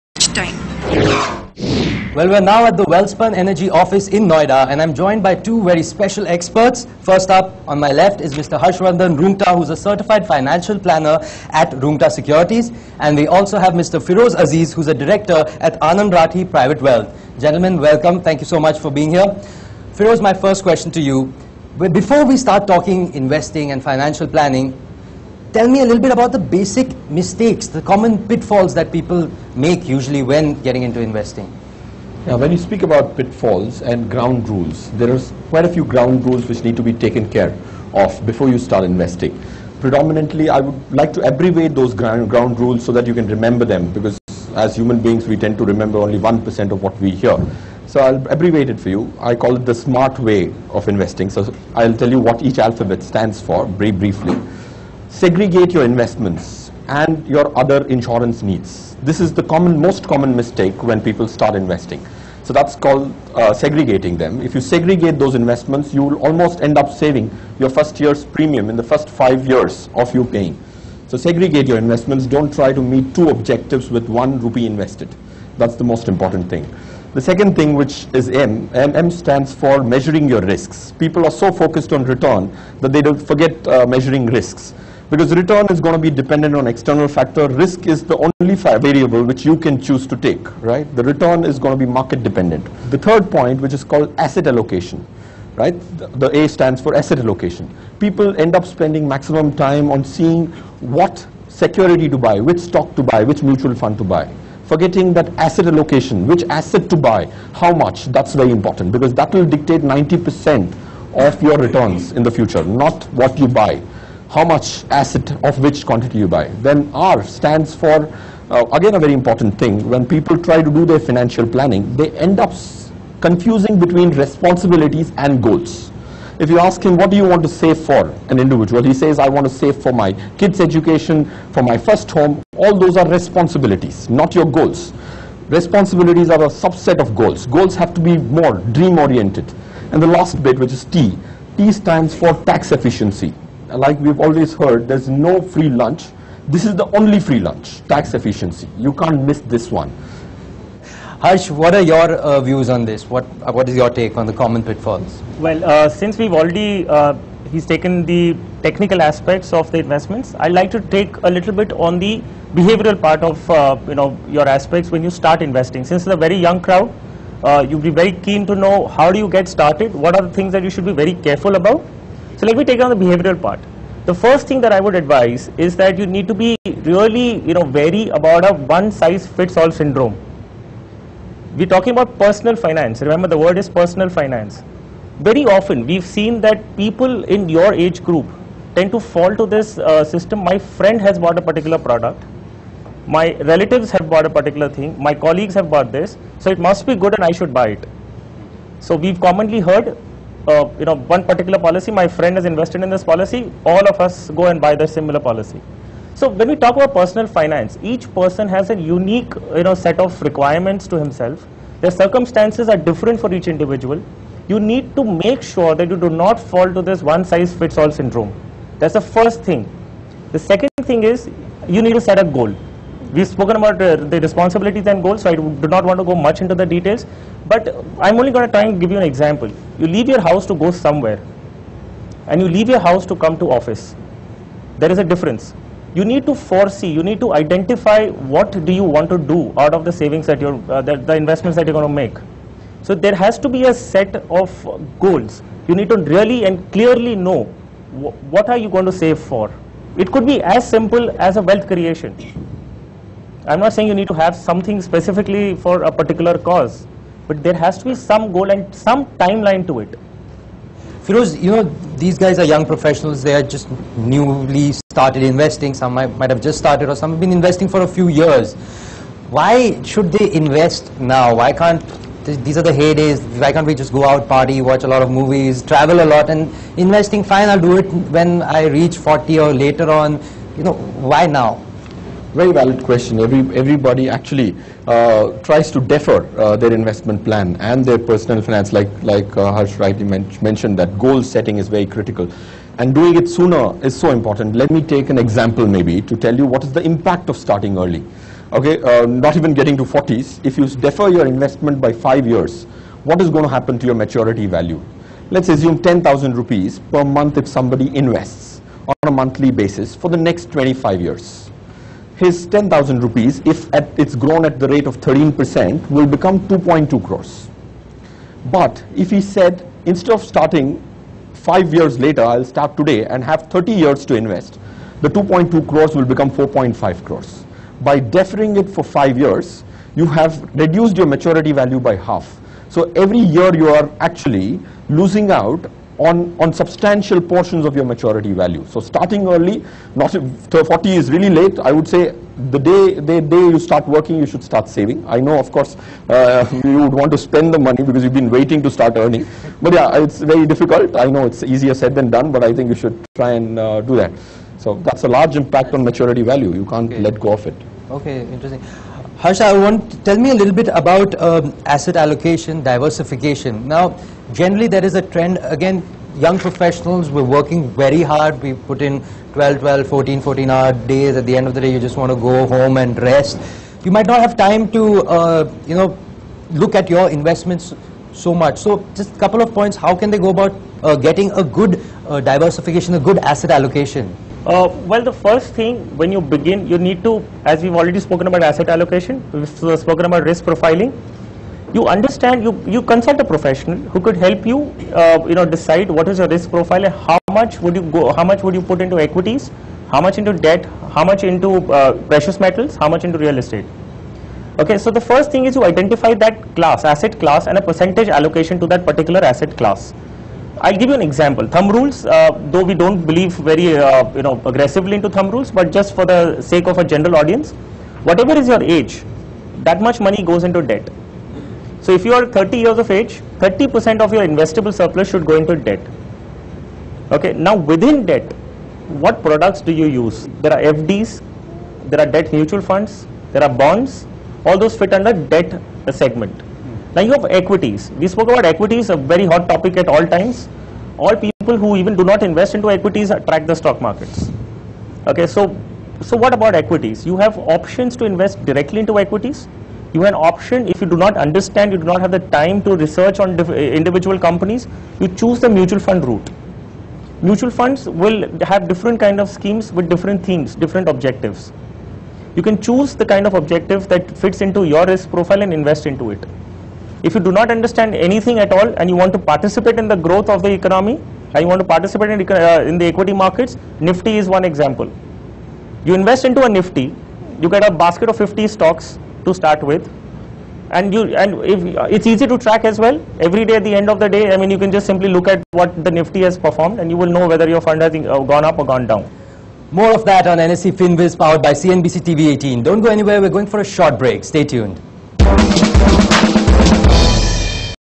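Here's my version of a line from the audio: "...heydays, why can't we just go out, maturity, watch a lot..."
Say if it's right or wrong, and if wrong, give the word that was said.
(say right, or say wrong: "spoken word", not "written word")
wrong: "party", not "maturity".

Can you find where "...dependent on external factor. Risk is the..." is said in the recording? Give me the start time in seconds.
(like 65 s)
86 s.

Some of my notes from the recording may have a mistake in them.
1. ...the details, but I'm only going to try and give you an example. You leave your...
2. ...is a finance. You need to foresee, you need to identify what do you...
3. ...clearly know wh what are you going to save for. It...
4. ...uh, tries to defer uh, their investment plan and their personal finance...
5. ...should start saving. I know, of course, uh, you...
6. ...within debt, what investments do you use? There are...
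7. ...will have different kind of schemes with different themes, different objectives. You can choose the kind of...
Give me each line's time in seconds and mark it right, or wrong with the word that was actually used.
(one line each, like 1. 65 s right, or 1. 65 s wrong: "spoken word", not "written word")
1. 226 s right
2. 234 s wrong: "difference", not "finance"
3. 246 s right
4. 284 s right
5. 344 s right
6. 427 s wrong: "products", not "investments"
7. 457 s right.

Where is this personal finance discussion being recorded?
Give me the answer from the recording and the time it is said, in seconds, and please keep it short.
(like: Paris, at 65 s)
Welspun Energy office in Noida, at 2 s.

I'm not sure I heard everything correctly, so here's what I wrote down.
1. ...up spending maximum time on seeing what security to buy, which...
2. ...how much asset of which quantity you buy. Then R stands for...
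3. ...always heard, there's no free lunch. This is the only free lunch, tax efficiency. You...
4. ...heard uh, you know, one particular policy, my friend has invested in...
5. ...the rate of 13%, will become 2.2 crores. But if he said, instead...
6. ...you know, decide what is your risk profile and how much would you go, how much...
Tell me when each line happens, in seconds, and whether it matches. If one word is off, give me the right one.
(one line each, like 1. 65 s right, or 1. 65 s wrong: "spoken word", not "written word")
1. 98 s right
2. 114 s right
3. 144 s right
4. 199 s right
5. 314 s right
6. 395 s right.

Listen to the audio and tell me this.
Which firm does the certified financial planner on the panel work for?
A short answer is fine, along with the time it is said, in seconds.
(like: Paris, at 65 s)
Rungta Securities, at 11 s.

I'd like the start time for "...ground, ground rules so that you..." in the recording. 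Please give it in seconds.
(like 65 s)
41 s.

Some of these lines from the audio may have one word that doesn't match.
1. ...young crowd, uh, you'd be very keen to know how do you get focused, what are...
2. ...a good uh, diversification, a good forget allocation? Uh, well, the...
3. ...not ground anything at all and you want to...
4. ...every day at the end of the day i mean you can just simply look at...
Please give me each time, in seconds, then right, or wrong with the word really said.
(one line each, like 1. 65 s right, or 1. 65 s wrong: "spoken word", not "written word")
1. 166 s wrong: "started", not "focused"
2. 381 s wrong: "asset", not "forget"
3. 467 s wrong: "understand", not "ground"
4. 483 s right.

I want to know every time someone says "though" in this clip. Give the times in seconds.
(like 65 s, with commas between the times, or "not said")
412 s.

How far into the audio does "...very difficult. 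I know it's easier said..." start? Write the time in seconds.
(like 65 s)
350 s.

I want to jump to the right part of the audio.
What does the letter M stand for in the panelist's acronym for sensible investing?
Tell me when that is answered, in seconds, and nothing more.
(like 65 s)
79 s.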